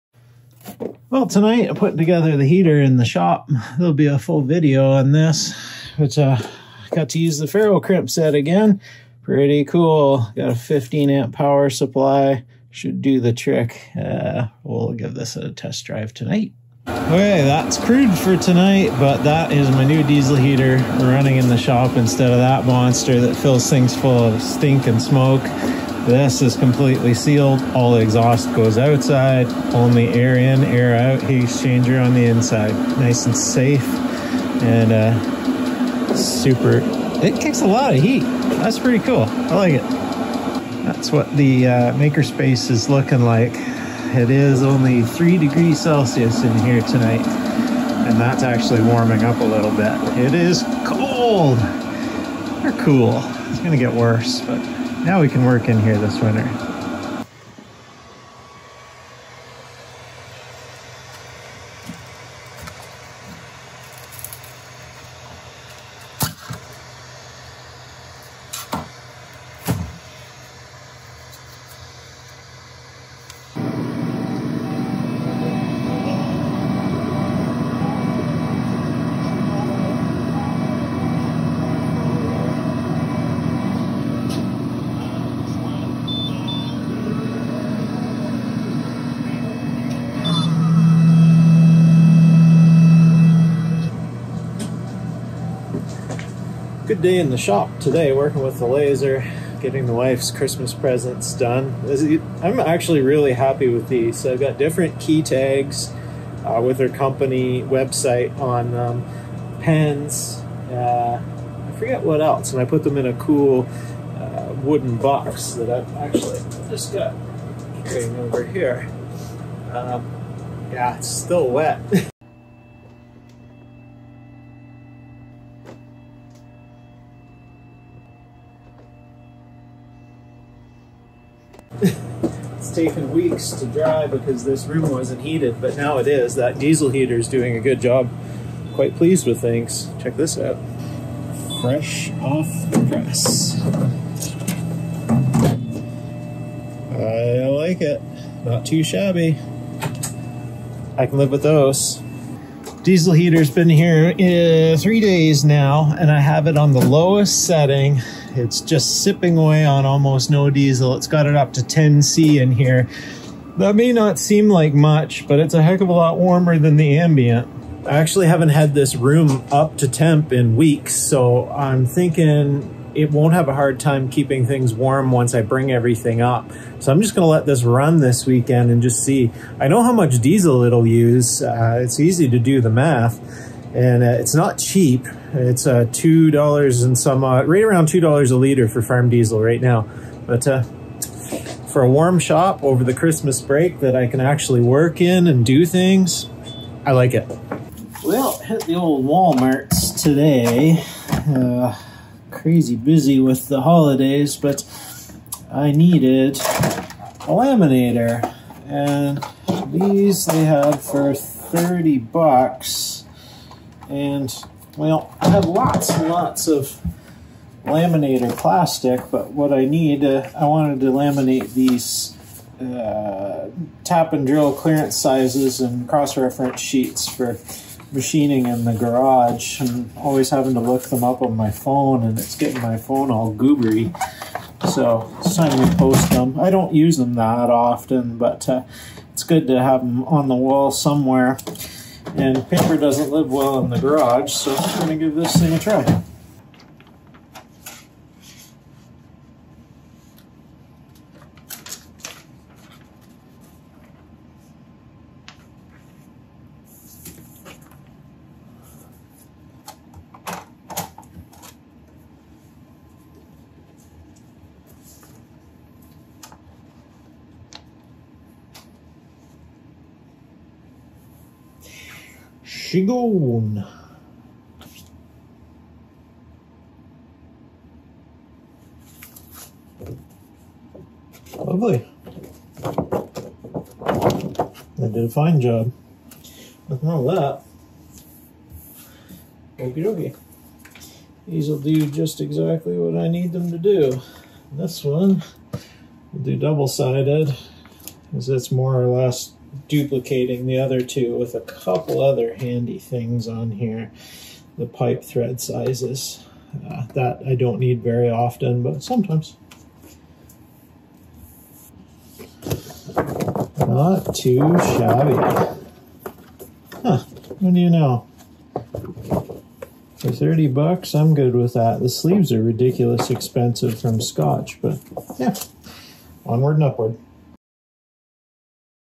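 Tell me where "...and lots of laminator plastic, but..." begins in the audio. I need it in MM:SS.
03:35.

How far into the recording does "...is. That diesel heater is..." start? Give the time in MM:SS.
02:16.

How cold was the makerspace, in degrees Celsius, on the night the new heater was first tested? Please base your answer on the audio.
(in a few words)
3.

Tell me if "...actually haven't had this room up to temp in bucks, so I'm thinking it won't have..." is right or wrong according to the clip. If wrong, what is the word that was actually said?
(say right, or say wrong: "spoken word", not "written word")
wrong: "weeks", not "bucks".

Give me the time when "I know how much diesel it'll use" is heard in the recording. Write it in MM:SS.
02:59.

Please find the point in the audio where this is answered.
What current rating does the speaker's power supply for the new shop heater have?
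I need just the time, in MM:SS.
00:10.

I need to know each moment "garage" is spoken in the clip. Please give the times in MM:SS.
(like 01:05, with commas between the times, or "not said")
03:48, 04:03.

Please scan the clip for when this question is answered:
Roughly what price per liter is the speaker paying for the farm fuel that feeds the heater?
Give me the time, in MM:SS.
03:07.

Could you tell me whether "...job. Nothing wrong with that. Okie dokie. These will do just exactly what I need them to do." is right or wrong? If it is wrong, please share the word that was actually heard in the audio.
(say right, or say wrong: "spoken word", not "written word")
right.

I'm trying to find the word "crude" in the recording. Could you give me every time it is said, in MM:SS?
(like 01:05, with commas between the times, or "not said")
00:17.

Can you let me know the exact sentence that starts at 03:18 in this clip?
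Well, hit the old Walmarts today.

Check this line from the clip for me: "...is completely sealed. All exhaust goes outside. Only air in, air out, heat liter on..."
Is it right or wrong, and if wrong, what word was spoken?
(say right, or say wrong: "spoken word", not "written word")
wrong: "exchanger", not "liter".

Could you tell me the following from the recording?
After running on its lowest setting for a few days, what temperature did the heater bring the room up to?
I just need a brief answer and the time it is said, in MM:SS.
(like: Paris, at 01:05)
10C, at 02:41.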